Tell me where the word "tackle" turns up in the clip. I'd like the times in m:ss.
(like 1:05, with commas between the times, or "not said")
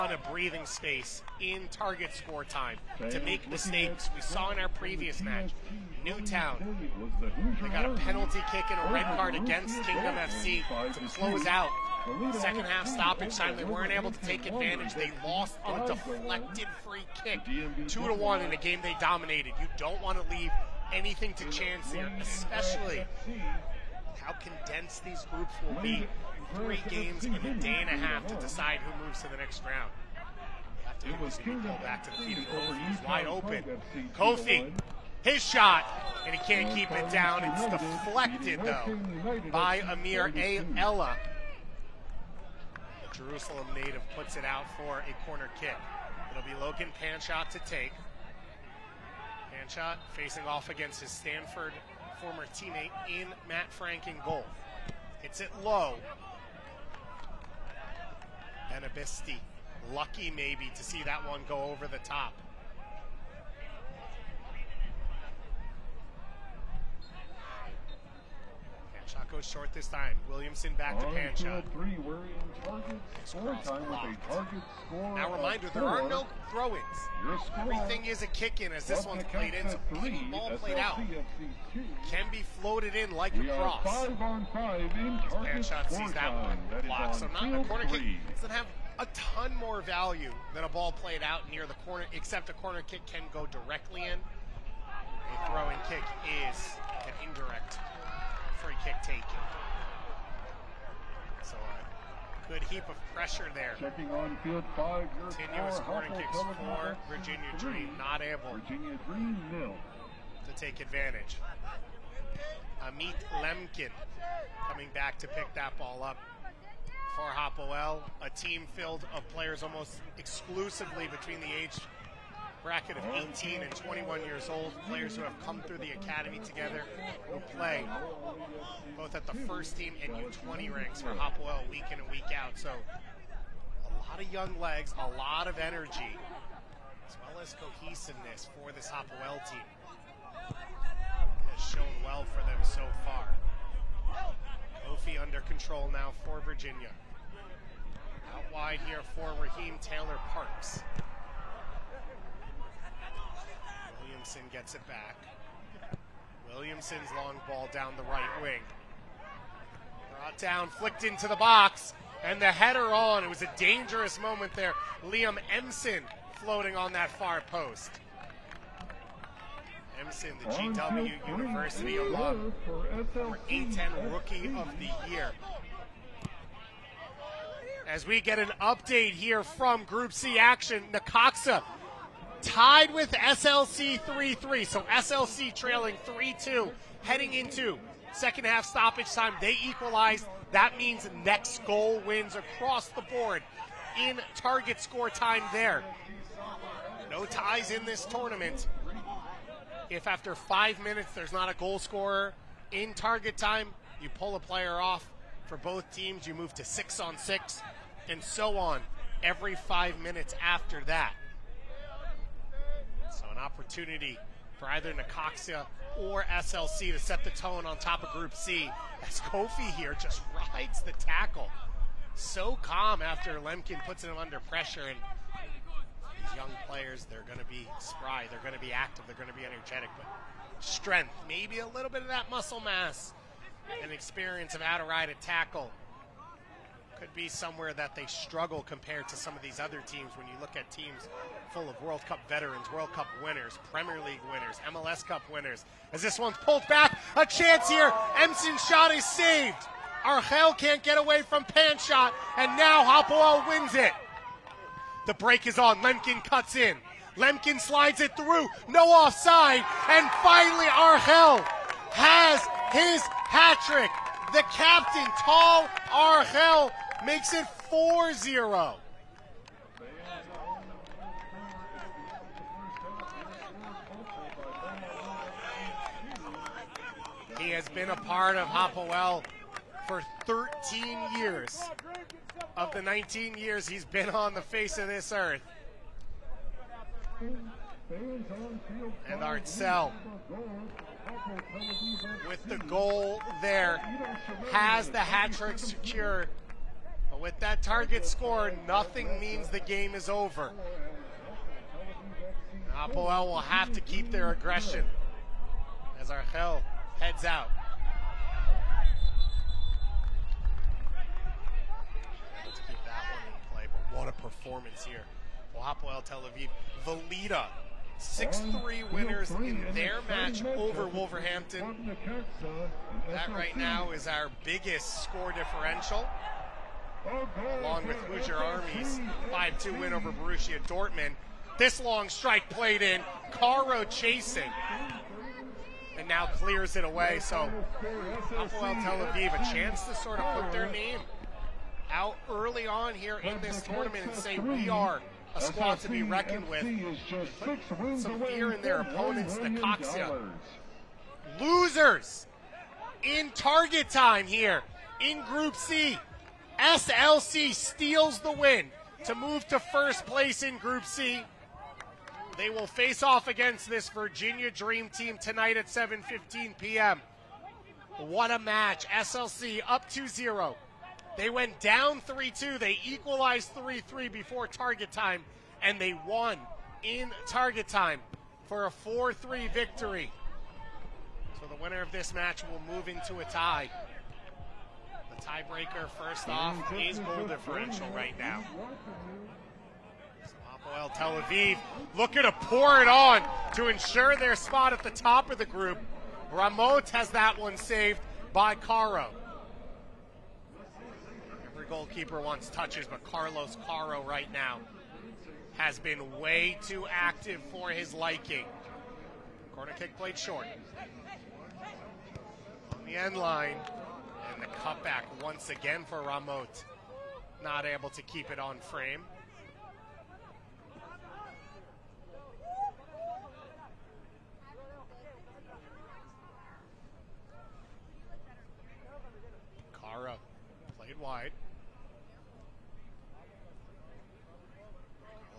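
3:40, 3:55.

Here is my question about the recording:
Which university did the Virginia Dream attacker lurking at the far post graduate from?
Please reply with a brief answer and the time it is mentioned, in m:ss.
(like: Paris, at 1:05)
GW University, at 2:50.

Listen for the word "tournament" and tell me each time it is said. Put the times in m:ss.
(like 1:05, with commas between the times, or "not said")
3:18, 5:43.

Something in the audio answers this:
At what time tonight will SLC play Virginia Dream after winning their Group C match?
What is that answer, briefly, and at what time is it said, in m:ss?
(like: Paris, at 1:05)
7:15 p.m., at 6:05.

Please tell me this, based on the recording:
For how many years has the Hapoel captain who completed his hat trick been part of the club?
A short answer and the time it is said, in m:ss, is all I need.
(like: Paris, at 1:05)
13, at 4:40.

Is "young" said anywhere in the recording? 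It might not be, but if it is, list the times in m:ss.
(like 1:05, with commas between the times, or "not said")
2:14, 3:46.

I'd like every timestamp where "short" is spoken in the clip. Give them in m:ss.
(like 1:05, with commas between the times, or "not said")
1:09, 6:50.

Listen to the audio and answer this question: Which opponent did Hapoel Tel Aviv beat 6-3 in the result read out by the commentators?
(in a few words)
Wolverhampton.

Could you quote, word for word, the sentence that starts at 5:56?
SLC steals the win to move to first place in Group C.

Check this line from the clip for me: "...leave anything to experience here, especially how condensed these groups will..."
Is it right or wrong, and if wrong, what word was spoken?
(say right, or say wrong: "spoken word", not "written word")
wrong: "chance", not "experience".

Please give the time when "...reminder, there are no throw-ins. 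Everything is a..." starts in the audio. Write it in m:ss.
1:15.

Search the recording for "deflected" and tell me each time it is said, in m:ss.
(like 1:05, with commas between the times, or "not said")
0:15, 0:37.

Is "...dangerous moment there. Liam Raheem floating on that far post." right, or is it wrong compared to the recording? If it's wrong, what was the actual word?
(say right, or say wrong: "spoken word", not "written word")
wrong: "Emson", not "Raheem".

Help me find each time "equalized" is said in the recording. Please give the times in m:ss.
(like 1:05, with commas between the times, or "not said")
3:09, 6:12.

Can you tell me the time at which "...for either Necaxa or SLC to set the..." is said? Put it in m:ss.
3:34.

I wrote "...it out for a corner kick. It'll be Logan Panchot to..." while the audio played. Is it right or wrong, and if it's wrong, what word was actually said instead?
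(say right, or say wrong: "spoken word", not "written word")
right.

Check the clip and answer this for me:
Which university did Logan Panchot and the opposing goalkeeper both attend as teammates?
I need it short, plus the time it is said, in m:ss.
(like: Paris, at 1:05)
Stanford, at 0:51.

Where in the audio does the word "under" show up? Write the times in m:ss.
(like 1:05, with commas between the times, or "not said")
2:25, 3:44.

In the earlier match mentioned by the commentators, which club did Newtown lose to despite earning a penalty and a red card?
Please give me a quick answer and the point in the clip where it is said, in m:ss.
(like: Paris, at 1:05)
Kingdom FC, at 0:09.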